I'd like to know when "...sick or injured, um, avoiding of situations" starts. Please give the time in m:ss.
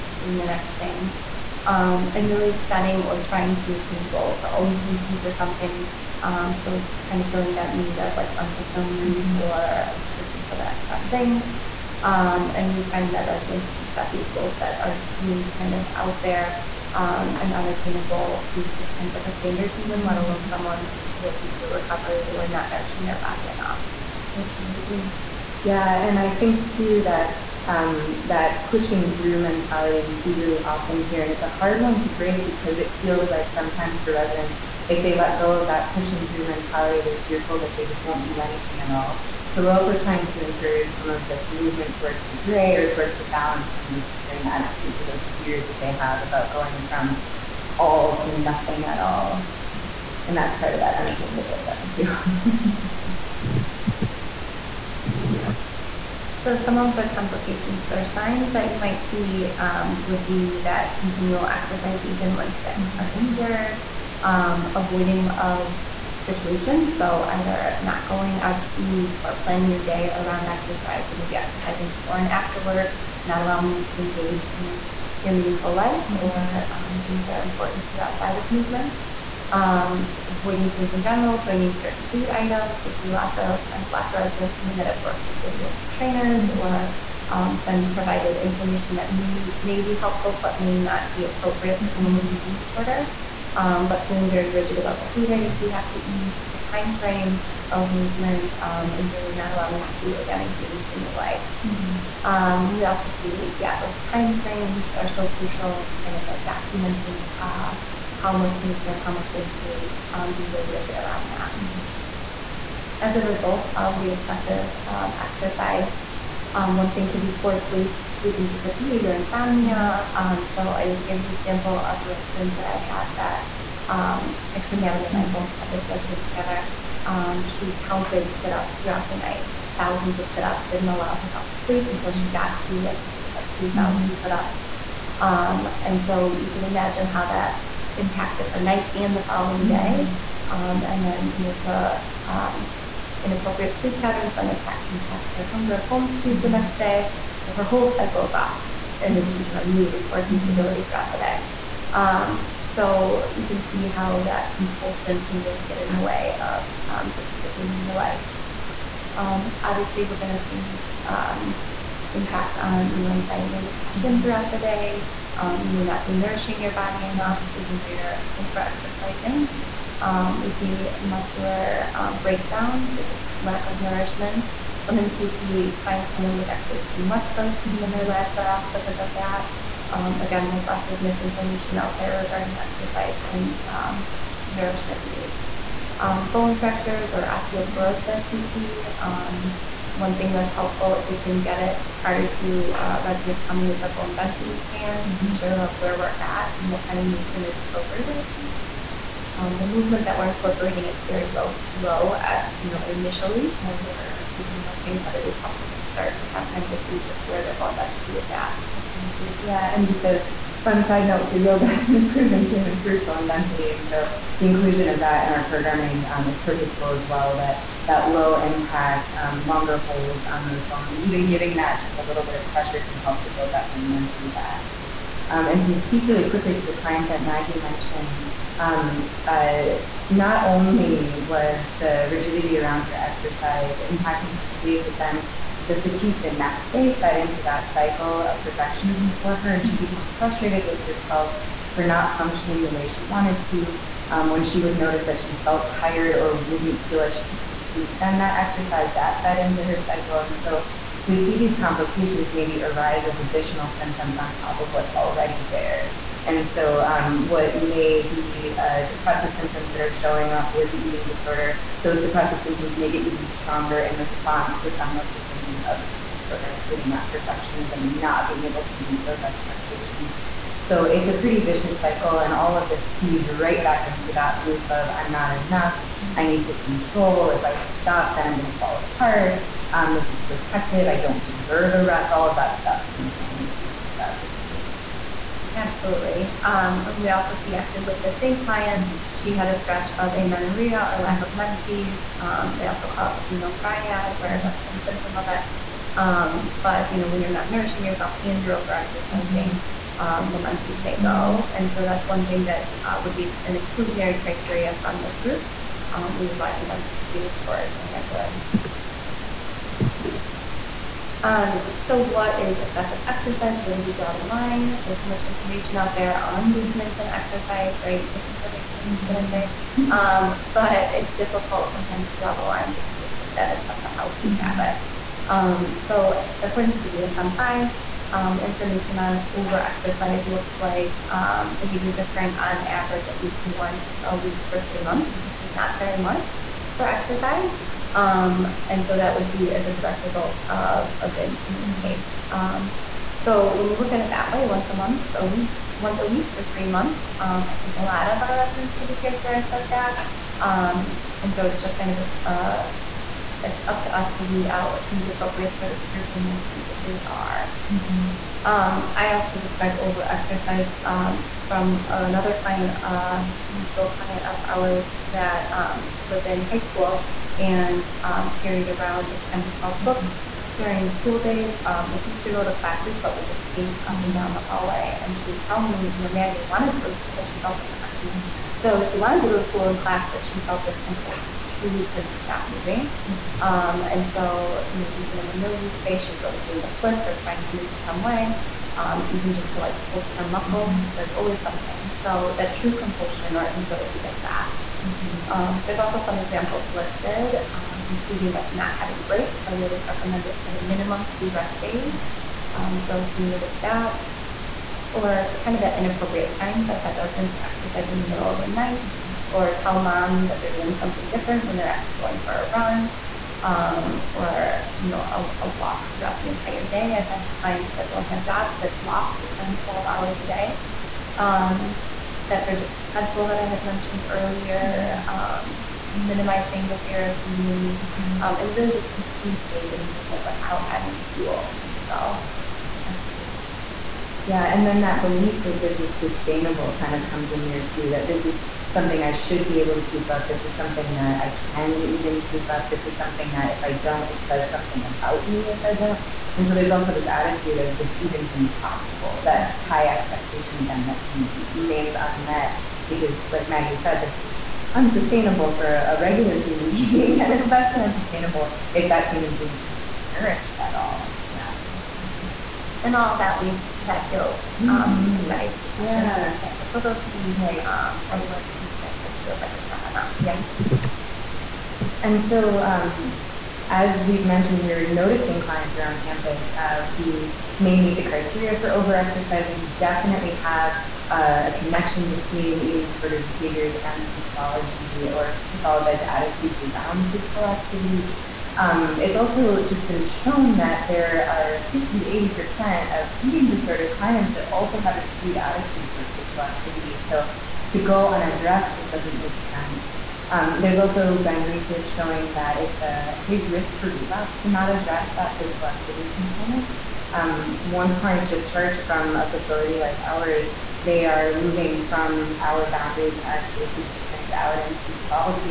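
1:02.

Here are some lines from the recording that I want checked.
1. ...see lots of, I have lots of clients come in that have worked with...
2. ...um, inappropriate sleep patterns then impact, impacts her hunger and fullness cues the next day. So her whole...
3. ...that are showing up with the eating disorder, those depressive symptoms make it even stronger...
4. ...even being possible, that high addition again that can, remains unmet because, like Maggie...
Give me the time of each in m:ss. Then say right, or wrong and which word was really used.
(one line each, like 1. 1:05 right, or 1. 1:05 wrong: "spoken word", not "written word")
1. 1:22 wrong: "residents", not "clients"
2. 2:22 right
3. 4:19 right
4. 7:28 wrong: "expectation", not "addition".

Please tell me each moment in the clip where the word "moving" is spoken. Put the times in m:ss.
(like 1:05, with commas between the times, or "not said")
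6:22, 8:31.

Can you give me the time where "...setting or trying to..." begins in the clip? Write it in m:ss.
0:02.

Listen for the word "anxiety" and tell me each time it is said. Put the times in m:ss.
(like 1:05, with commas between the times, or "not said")
2:43, 7:45.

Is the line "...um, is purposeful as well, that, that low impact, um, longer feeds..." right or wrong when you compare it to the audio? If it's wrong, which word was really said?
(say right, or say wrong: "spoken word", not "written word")
wrong: "holds", not "feeds".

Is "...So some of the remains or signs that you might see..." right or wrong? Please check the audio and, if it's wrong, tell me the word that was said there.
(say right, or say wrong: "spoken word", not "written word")
wrong: "complications", not "remains".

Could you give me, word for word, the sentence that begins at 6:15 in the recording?
And she would tell me, you know, Maggie wanted to go to school.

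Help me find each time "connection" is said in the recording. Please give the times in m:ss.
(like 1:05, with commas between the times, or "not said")
8:01.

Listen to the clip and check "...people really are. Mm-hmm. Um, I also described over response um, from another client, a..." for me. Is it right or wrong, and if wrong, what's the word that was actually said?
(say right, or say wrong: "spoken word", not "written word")
wrong: "exercise", not "response".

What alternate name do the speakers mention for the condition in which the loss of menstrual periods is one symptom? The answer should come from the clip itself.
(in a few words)
female triad.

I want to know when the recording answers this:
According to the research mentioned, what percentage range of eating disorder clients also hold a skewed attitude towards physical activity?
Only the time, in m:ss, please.
8:11.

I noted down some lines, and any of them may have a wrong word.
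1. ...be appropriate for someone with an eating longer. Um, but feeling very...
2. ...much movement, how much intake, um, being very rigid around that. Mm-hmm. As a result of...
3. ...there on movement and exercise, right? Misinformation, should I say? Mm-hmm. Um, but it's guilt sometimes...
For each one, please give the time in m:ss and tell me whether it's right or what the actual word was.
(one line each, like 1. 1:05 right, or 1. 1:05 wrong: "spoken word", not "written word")
1. 1:31 wrong: "disorder", not "longer"
2. 1:48 right
3. 5:15 wrong: "difficult", not "guilt".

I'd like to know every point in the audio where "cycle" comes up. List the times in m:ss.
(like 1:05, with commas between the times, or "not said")
2:27, 3:57, 4:09, 4:31.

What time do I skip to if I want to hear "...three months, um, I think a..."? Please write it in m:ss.
5:46.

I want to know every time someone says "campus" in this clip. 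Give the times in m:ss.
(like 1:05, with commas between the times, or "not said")
7:56.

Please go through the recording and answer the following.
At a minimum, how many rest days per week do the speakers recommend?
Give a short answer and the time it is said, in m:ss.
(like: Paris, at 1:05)
2, at 6:41.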